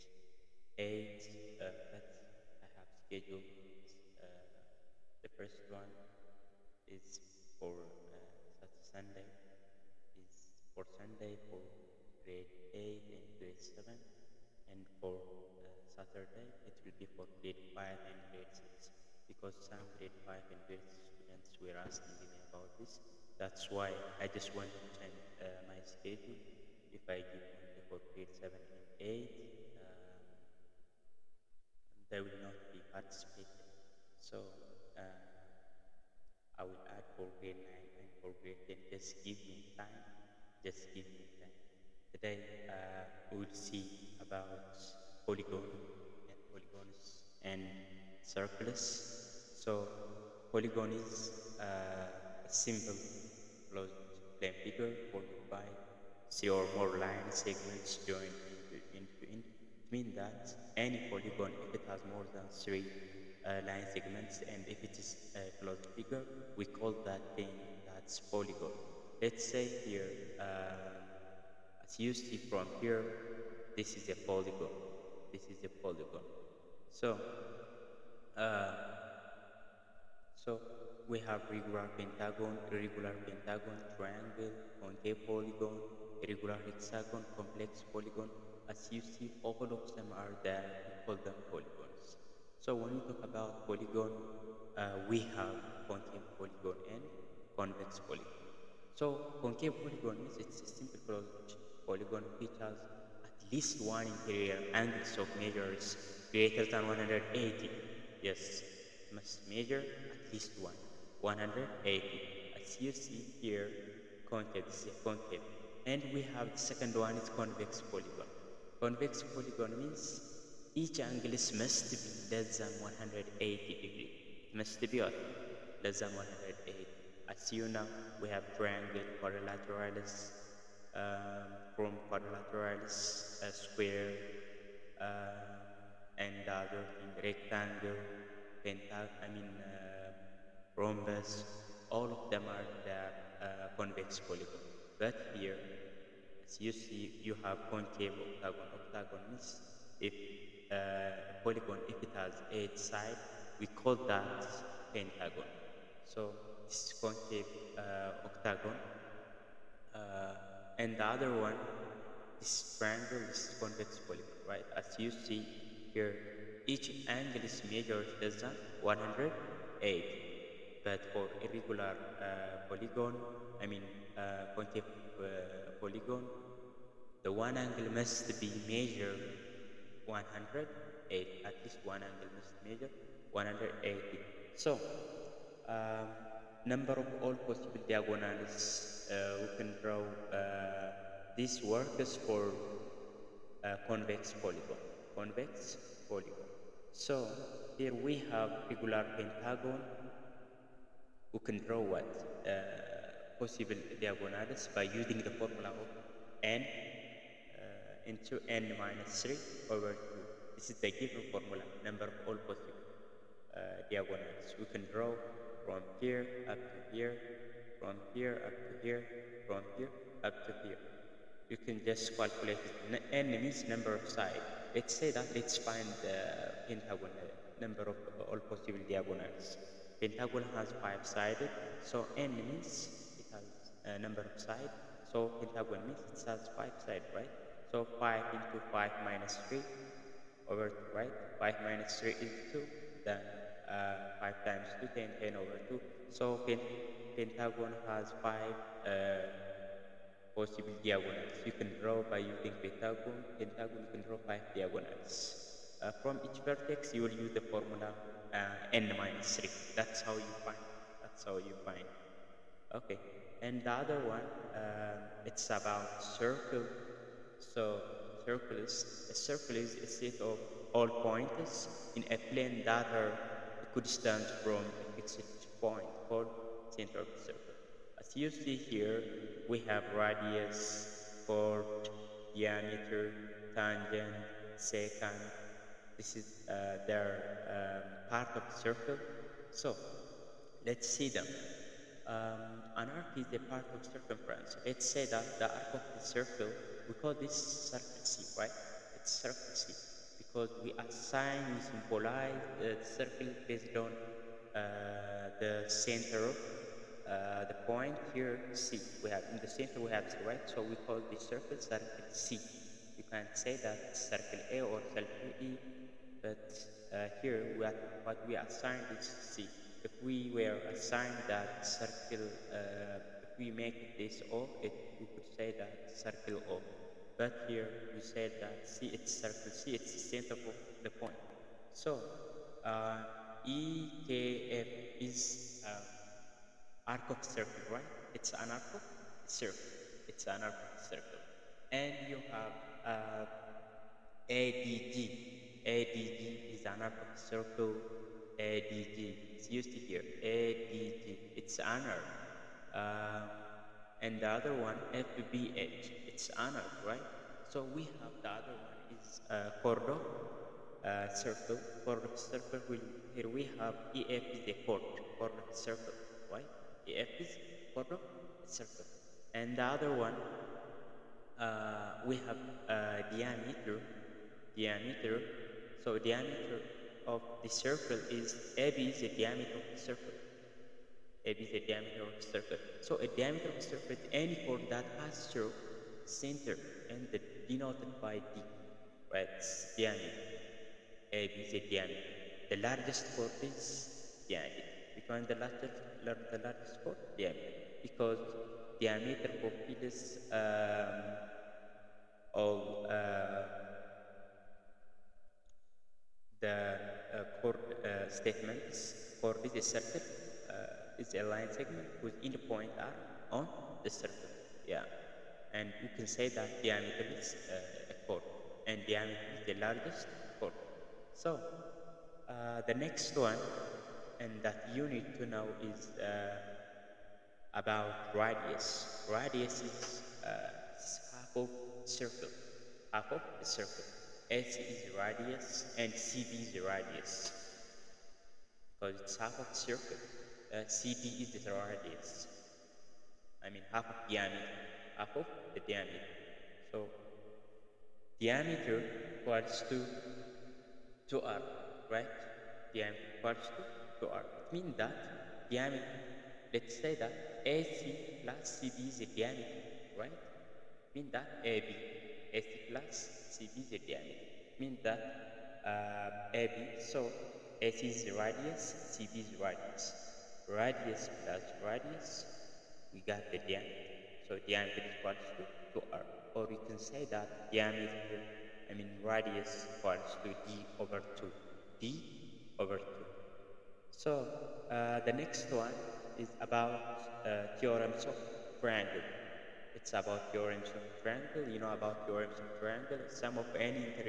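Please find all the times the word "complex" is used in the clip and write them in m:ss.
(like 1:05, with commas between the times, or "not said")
1:27.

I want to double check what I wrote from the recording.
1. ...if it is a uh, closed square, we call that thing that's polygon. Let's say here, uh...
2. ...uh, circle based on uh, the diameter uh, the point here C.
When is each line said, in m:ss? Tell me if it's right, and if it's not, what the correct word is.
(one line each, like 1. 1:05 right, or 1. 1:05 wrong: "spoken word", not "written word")
1. 1:04 wrong: "figure", not "square"
2. 5:02 wrong: "center", not "diameter".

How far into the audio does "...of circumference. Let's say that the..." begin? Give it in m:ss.
4:53.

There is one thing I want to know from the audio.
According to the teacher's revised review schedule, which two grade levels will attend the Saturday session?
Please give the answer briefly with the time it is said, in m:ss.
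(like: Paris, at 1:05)
grade 5 and grade 6, at 0:17.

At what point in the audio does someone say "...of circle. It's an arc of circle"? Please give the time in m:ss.
5:38.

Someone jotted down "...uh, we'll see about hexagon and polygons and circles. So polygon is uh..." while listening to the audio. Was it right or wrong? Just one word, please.
wrong.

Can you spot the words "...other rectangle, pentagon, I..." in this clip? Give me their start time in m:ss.
2:16.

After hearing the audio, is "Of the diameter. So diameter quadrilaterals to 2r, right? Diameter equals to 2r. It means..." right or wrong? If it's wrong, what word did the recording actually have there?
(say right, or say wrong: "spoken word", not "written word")
wrong: "equals", not "quadrilaterals".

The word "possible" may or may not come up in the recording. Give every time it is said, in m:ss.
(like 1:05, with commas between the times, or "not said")
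3:07, 3:23, 3:32, 3:48, 4:10.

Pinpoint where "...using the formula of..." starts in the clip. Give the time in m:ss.
3:25.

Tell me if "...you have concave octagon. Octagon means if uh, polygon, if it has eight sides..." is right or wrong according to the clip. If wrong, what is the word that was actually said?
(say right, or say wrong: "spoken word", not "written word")
right.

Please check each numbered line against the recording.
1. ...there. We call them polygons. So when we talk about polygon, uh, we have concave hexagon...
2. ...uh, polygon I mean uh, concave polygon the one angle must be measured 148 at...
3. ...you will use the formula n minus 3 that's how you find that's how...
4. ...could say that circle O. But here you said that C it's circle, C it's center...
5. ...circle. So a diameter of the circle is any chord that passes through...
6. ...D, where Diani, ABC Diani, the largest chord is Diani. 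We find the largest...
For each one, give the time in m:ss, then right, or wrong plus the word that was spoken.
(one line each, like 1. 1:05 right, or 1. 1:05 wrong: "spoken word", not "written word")
1. 1:30 wrong: "polygon", not "hexagon"
2. 2:52 wrong: "108", not "148"
3. 4:16 right
4. 5:25 right
5. 6:22 right
6. 6:28 right.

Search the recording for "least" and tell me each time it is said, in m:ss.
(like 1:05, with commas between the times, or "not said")
1:43, 1:50, 3:01.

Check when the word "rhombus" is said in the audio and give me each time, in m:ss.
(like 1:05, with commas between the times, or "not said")
2:20.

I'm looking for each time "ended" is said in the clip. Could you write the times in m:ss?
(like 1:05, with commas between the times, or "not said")
6:26.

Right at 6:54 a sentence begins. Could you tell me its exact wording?
Yeah and you can say that diameter is uh, a chord and diameter is the largest chord.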